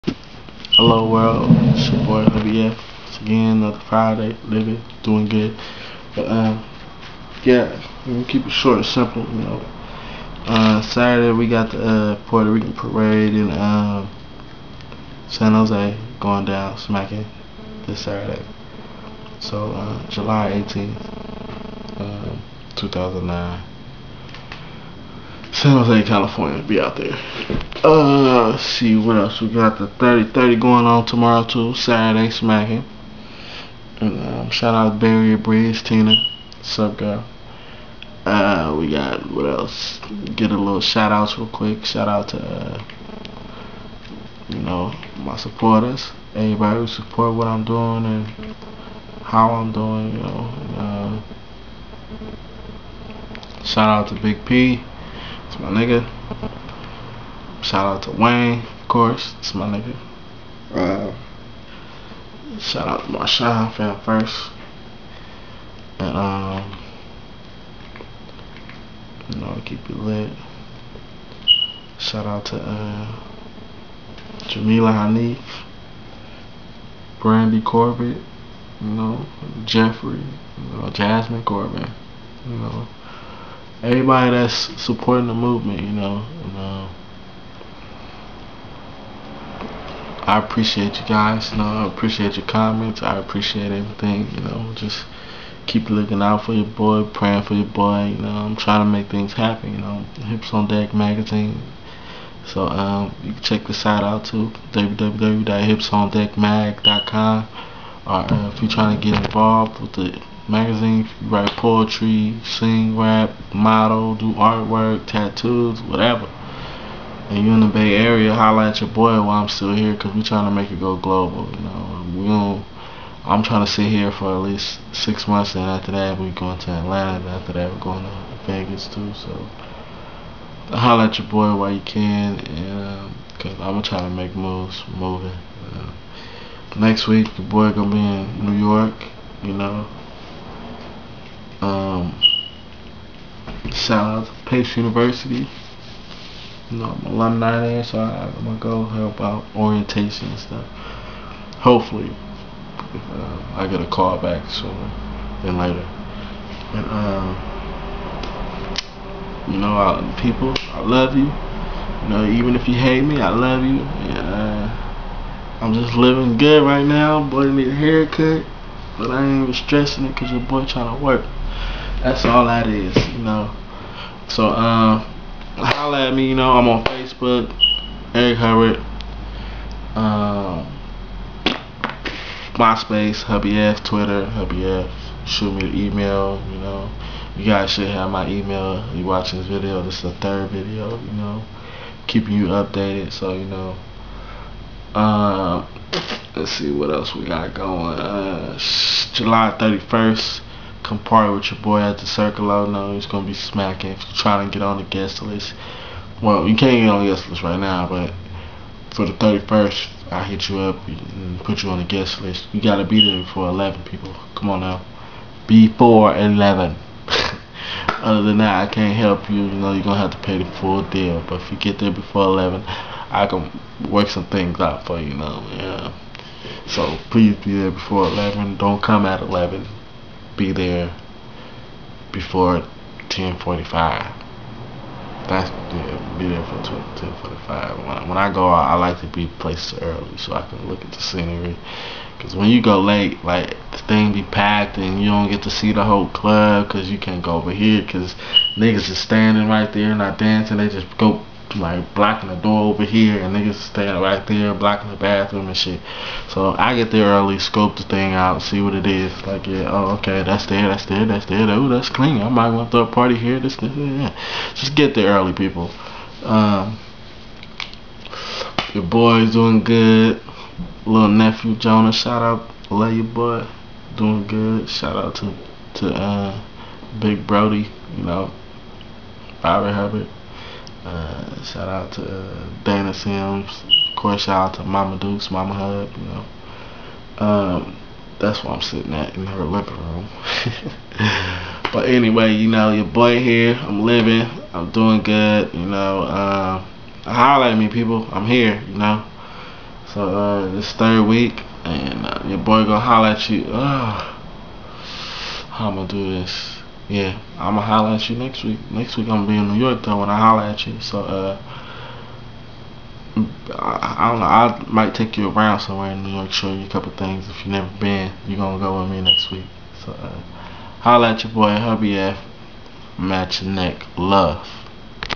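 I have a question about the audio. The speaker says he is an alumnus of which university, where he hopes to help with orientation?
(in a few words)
Pace University.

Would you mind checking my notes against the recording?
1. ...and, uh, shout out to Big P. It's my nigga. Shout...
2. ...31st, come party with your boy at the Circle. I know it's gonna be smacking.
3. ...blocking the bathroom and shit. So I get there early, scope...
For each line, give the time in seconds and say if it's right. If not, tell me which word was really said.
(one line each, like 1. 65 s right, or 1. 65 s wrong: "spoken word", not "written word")
1. 50 s right
2. 199 s right
3. 254 s right.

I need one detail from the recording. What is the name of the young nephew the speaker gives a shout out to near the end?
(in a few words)
Jonah.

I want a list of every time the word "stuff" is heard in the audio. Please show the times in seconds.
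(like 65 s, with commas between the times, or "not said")
150 s.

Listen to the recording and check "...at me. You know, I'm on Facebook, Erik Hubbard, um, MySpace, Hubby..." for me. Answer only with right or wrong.
right.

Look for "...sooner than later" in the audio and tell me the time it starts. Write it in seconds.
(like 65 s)
154 s.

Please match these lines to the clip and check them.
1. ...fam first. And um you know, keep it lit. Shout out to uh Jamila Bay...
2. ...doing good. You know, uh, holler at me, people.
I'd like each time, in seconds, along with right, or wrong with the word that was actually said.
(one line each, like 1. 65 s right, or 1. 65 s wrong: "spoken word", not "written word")
1. 63 s wrong: "Hanif", not "Bay"
2. 294 s right.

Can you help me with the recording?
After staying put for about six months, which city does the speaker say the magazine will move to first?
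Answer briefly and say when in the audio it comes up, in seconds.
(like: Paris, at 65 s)
Atlanta, at 126 s.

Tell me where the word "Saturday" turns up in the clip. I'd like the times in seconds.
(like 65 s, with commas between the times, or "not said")
10 s, 18 s, 31 s.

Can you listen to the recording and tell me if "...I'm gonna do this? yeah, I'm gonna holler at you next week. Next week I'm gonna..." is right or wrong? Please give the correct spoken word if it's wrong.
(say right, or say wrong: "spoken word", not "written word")
right.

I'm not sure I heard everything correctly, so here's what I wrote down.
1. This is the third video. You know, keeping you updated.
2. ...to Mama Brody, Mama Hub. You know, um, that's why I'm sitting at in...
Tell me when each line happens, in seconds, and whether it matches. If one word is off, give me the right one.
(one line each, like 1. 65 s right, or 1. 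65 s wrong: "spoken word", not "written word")
1. 189 s right
2. 284 s wrong: "Dukes", not "Brody".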